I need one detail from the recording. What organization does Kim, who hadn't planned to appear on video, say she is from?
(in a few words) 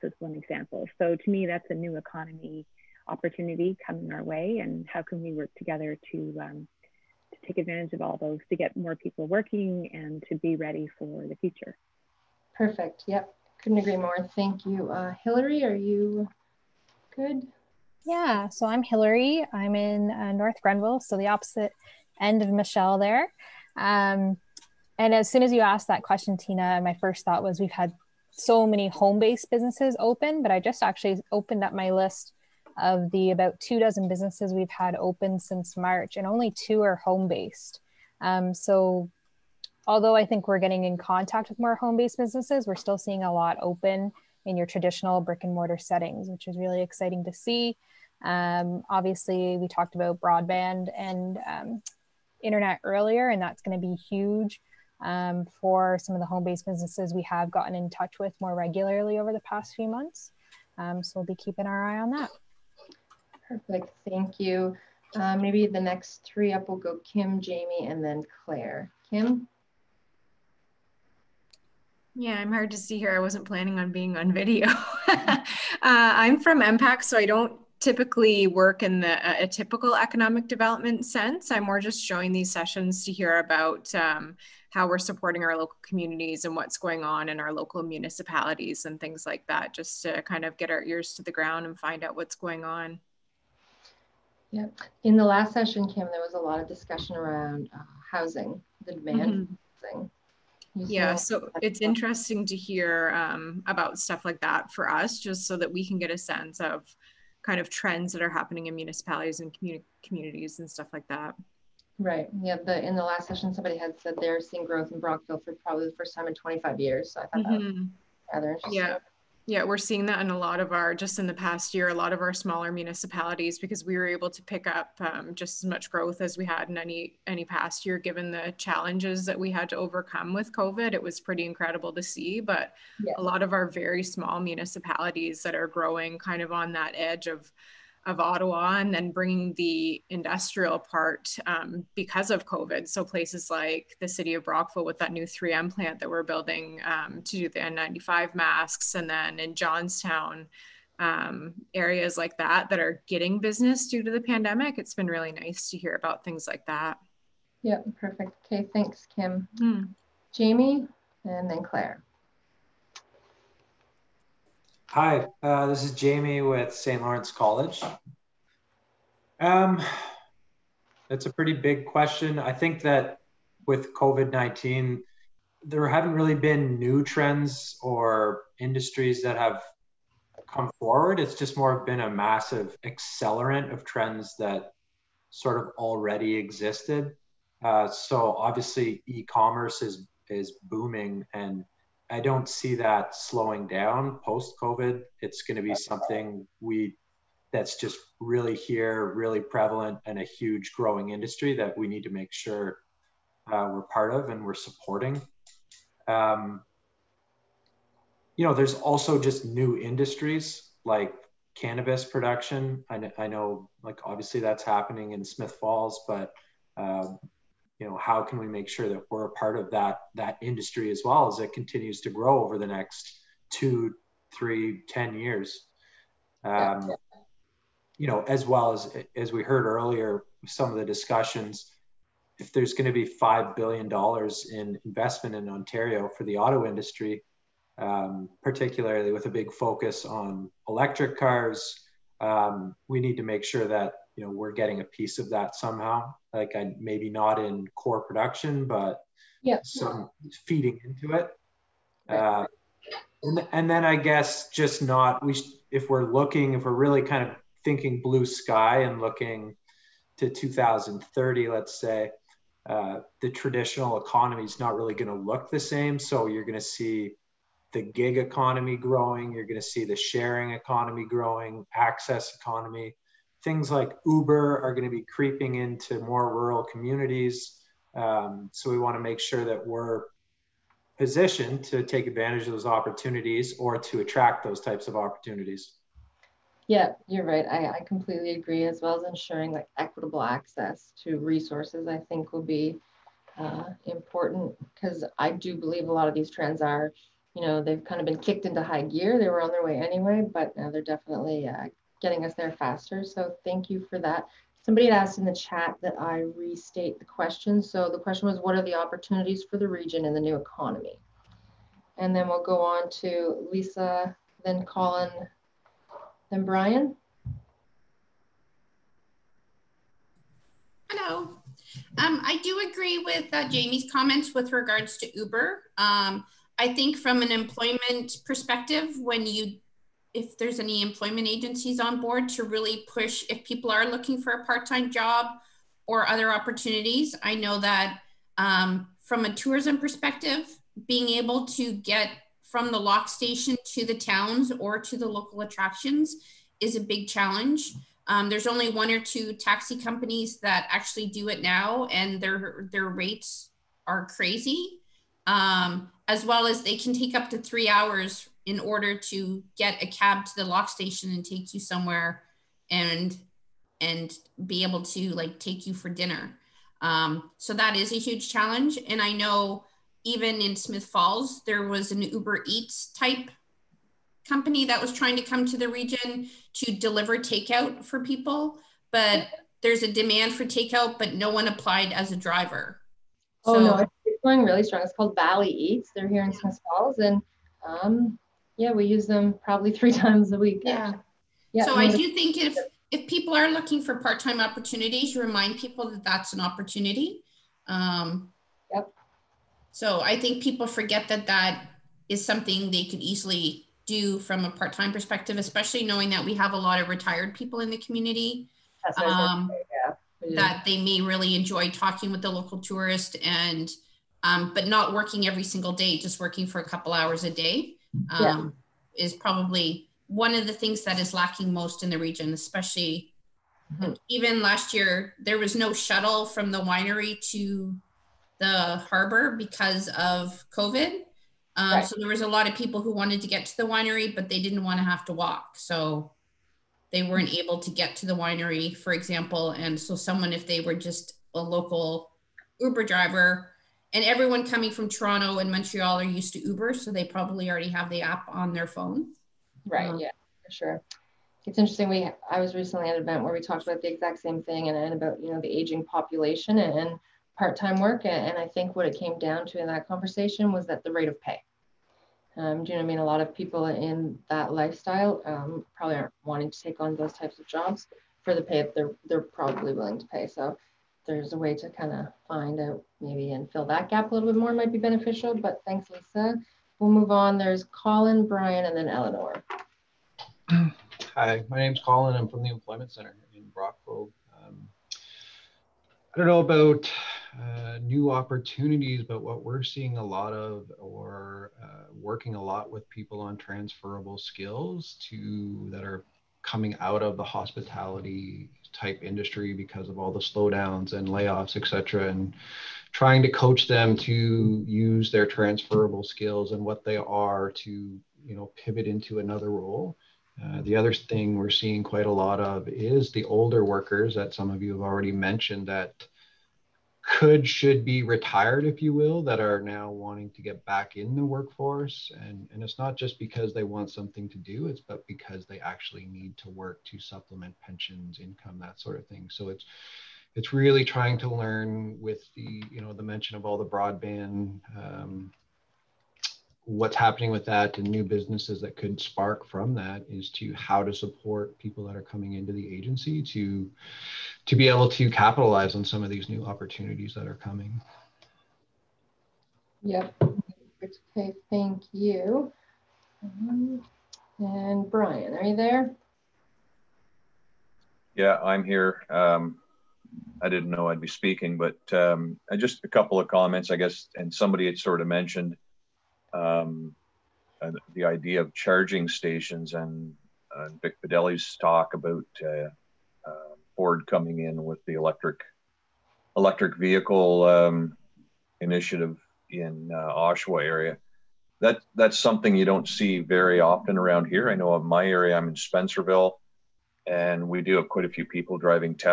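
MPAC.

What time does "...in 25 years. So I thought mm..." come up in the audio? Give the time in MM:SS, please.
01:56.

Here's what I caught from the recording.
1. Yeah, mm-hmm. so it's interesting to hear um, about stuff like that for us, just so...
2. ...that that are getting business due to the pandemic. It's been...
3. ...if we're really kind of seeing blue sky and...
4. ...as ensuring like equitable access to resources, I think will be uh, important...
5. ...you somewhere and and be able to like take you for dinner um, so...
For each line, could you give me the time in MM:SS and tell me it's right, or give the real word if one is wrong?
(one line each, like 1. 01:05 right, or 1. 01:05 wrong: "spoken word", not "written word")
1. 01:40 right
2. 02:32 right
3. 04:16 wrong: "thinking", not "seeing"
4. 04:48 right
5. 06:01 right.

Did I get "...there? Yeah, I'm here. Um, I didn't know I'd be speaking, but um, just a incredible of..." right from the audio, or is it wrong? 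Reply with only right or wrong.
wrong.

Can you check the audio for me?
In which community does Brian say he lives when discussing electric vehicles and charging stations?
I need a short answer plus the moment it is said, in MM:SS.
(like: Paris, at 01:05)
Spencerville, at 09:45.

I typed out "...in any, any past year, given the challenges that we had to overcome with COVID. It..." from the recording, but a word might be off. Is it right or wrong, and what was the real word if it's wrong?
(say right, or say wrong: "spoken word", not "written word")
right.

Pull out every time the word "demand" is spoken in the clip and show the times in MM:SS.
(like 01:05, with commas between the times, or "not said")
01:38, 06:19.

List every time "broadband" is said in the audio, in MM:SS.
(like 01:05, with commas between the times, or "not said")
00:50, 08:53.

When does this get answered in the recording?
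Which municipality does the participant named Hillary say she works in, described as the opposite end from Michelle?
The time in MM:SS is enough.
00:20.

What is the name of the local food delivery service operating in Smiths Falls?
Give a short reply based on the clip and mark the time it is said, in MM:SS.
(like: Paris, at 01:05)
Valley Eats, at 06:25.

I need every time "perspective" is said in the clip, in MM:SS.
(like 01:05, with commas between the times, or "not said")
05:28, 05:39, 06:44.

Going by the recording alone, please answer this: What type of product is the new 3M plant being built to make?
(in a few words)
N95 masks.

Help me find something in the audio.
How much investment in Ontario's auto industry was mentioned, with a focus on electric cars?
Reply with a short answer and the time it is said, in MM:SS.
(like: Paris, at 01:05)
5 billion dollars, at 03:53.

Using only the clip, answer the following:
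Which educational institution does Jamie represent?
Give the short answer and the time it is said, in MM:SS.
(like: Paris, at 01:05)
St. Lawrence College, at 02:46.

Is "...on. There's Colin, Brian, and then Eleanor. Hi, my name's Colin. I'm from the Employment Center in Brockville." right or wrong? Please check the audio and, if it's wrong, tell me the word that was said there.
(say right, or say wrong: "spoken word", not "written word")
right.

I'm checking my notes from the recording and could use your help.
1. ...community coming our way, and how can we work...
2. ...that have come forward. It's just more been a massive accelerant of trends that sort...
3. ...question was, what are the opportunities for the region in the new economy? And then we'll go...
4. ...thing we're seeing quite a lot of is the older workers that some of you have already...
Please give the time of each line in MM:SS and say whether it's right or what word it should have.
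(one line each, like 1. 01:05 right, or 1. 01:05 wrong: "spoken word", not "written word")
1. 00:03 wrong: "opportunity", not "community"
2. 02:59 right
3. 05:07 right
4. 08:30 right.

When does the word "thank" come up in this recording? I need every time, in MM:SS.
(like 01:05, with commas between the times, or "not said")
00:14, 01:04, 02:38, 05:03, 07:55, 09:11.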